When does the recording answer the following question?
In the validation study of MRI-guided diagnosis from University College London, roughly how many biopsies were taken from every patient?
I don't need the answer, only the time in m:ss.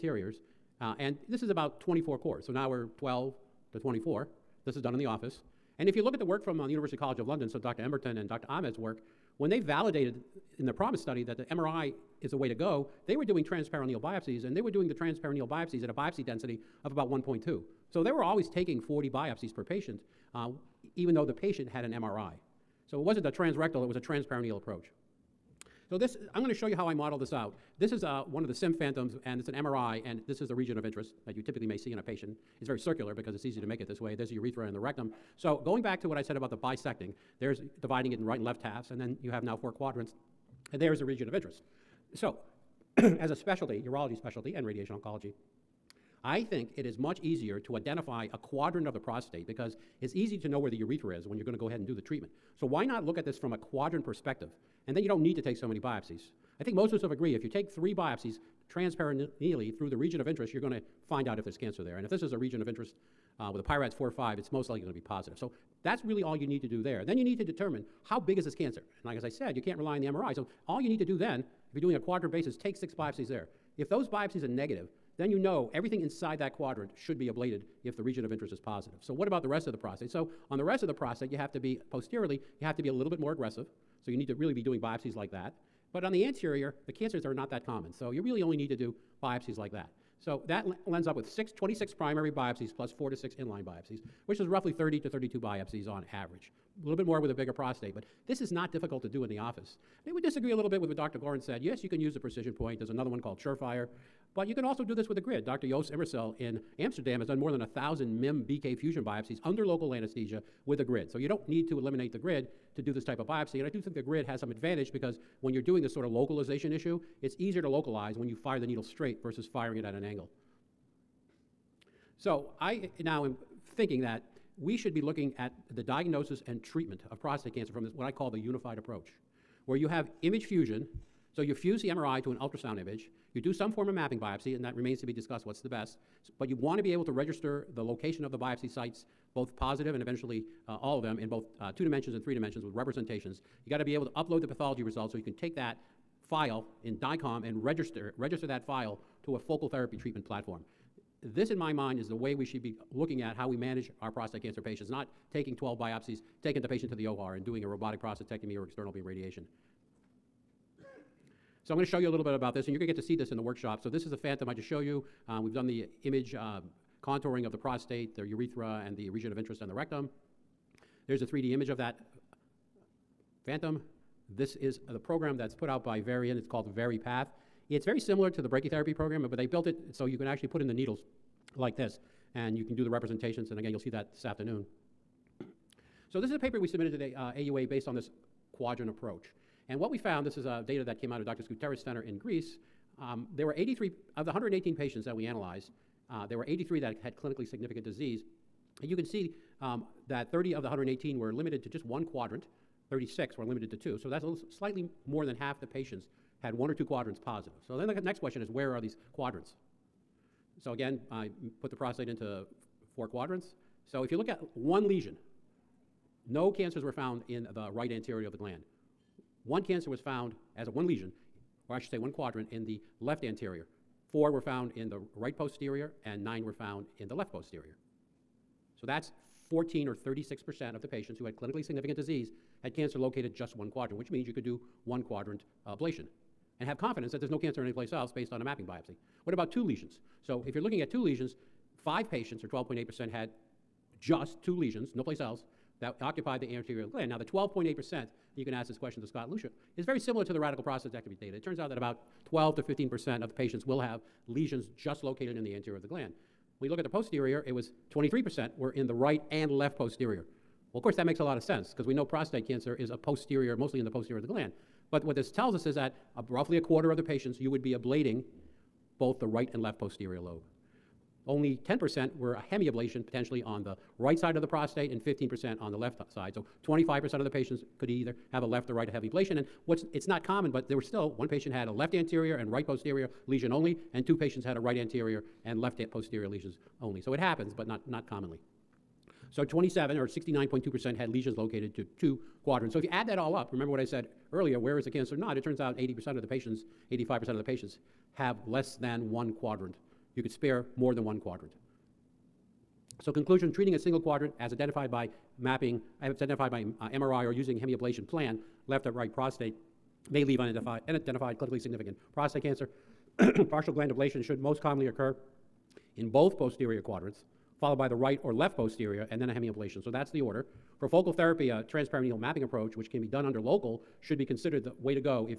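0:18.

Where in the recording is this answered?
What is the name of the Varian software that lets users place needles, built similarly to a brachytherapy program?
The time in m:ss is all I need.
2:56.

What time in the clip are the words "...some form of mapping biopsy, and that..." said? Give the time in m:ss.
2:13.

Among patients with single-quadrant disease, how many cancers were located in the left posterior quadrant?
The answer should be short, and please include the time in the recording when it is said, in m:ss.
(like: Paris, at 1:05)
9, at 3:46.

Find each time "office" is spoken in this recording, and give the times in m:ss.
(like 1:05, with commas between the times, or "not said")
0:05, 1:39.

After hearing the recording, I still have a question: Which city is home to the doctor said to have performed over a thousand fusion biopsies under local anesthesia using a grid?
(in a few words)
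Amsterdam.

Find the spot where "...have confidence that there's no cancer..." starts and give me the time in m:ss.
3:56.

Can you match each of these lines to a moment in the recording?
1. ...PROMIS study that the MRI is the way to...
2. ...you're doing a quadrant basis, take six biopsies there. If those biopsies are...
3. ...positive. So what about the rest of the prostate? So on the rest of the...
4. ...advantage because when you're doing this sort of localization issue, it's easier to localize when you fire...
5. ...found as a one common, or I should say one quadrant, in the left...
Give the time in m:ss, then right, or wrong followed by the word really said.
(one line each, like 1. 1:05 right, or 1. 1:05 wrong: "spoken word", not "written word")
1. 0:10 right
2. 1:11 right
3. 1:18 right
4. 1:54 right
5. 3:39 wrong: "lesion", not "common".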